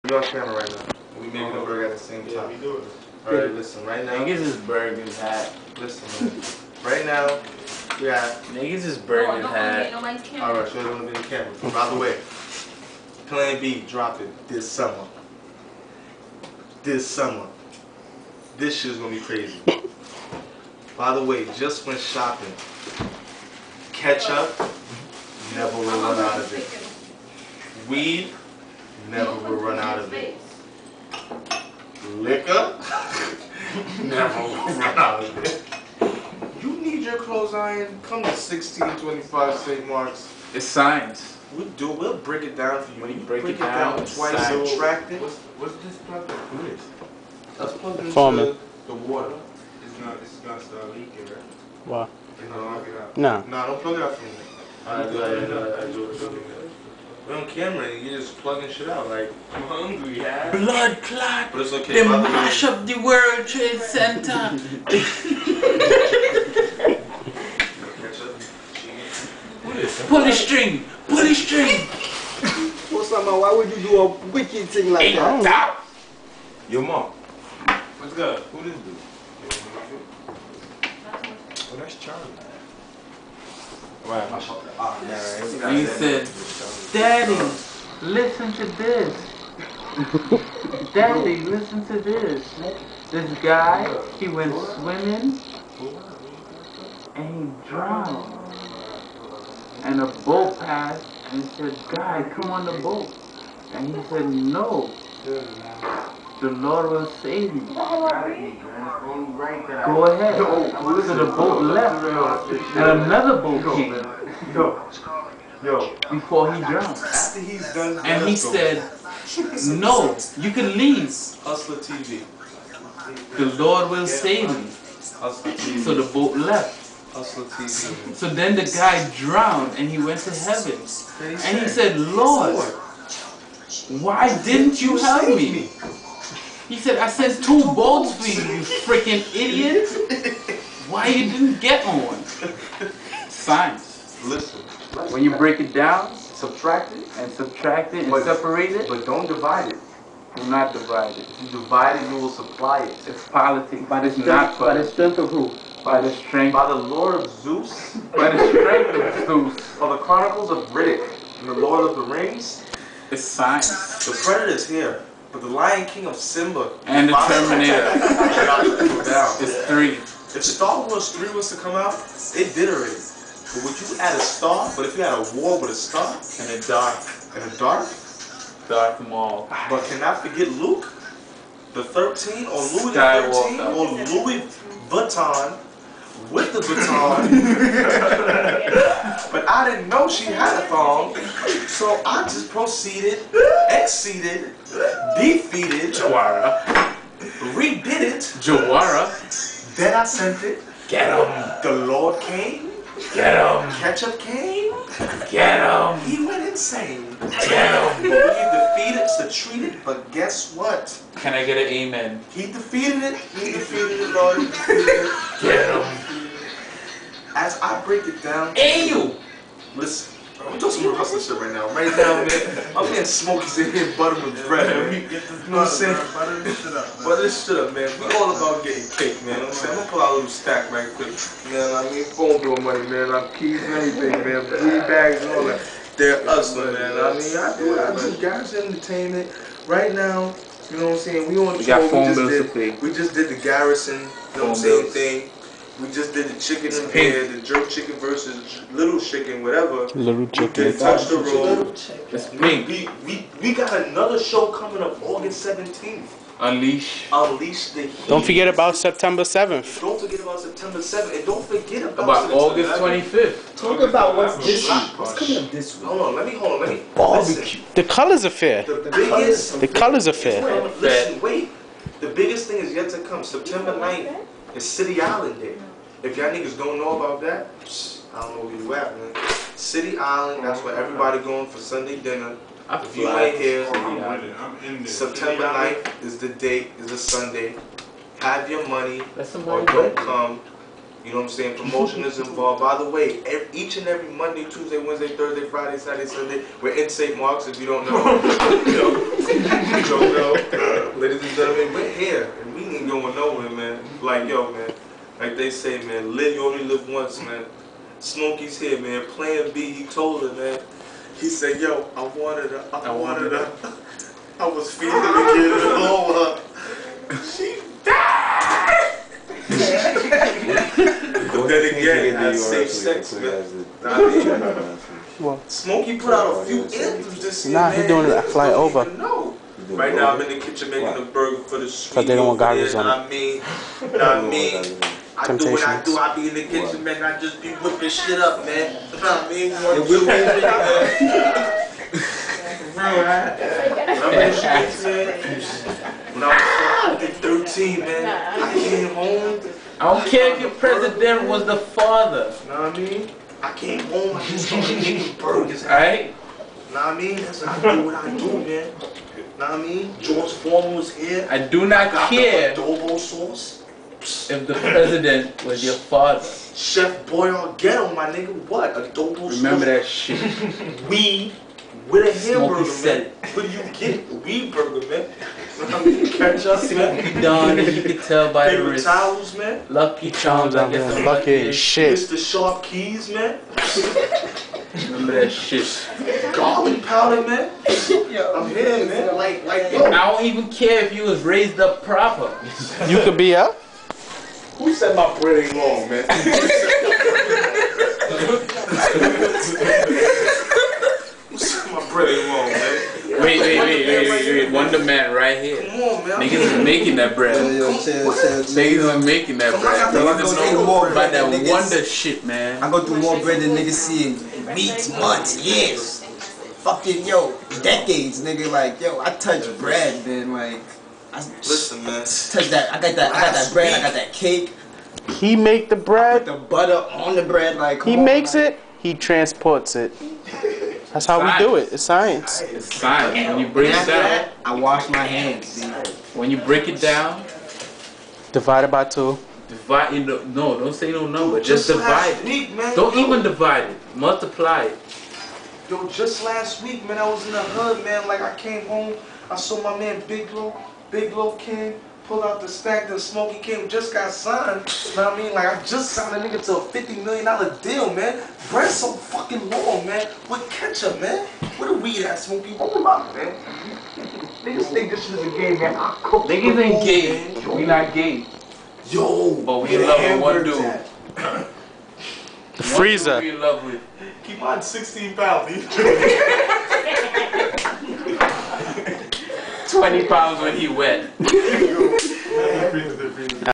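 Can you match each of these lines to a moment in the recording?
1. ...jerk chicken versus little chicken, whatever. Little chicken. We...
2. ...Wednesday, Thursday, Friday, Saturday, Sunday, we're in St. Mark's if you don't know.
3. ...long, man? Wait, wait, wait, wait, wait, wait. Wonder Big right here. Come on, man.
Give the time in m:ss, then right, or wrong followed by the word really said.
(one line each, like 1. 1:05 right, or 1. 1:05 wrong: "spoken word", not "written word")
1. 4:07 right
2. 4:54 right
3. 6:42 wrong: "Man", not "Big".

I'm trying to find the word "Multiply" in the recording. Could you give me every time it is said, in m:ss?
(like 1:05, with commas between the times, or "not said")
7:23.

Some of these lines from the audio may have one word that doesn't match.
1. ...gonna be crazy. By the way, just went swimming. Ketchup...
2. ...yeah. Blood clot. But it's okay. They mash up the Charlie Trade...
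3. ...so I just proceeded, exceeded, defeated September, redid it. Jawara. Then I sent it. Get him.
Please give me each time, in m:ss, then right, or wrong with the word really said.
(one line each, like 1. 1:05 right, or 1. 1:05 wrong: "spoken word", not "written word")
1. 0:18 wrong: "shopping", not "swimming"
2. 1:00 wrong: "World", not "Charlie"
3. 3:11 wrong: "Jawara", not "September".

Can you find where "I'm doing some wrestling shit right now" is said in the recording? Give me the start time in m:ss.
3:40.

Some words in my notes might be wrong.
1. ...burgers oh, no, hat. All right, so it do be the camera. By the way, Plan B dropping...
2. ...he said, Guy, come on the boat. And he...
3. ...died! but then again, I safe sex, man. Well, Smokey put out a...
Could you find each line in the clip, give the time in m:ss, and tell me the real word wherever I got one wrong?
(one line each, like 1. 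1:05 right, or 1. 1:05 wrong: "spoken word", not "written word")
1. 0:08 right
2. 1:41 right
3. 5:17 right.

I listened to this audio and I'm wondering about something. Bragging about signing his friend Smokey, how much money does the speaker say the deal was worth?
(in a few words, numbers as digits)
$50 million.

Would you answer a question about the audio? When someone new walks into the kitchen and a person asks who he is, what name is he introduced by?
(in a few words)
Charlie.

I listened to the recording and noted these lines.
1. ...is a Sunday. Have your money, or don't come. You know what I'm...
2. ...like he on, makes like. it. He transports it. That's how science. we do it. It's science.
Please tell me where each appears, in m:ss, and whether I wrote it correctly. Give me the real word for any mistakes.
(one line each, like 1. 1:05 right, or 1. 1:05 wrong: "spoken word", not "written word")
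1. 4:46 right
2. 7:07 right.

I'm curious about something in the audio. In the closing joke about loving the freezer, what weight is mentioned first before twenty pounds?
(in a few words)
16 pounds.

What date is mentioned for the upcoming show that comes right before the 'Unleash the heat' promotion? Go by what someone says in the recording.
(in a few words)
August 17th.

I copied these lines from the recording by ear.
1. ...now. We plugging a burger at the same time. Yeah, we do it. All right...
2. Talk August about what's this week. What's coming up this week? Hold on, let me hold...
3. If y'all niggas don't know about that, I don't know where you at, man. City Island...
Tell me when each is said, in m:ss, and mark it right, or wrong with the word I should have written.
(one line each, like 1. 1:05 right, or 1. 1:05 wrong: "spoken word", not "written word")
1. 0:00 wrong: "making", not "plugging"
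2. 4:23 right
3. 4:36 right.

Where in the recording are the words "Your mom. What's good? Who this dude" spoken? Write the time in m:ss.
1:16.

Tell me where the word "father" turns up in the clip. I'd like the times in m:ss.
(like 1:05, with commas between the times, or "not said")
5:51, 6:05.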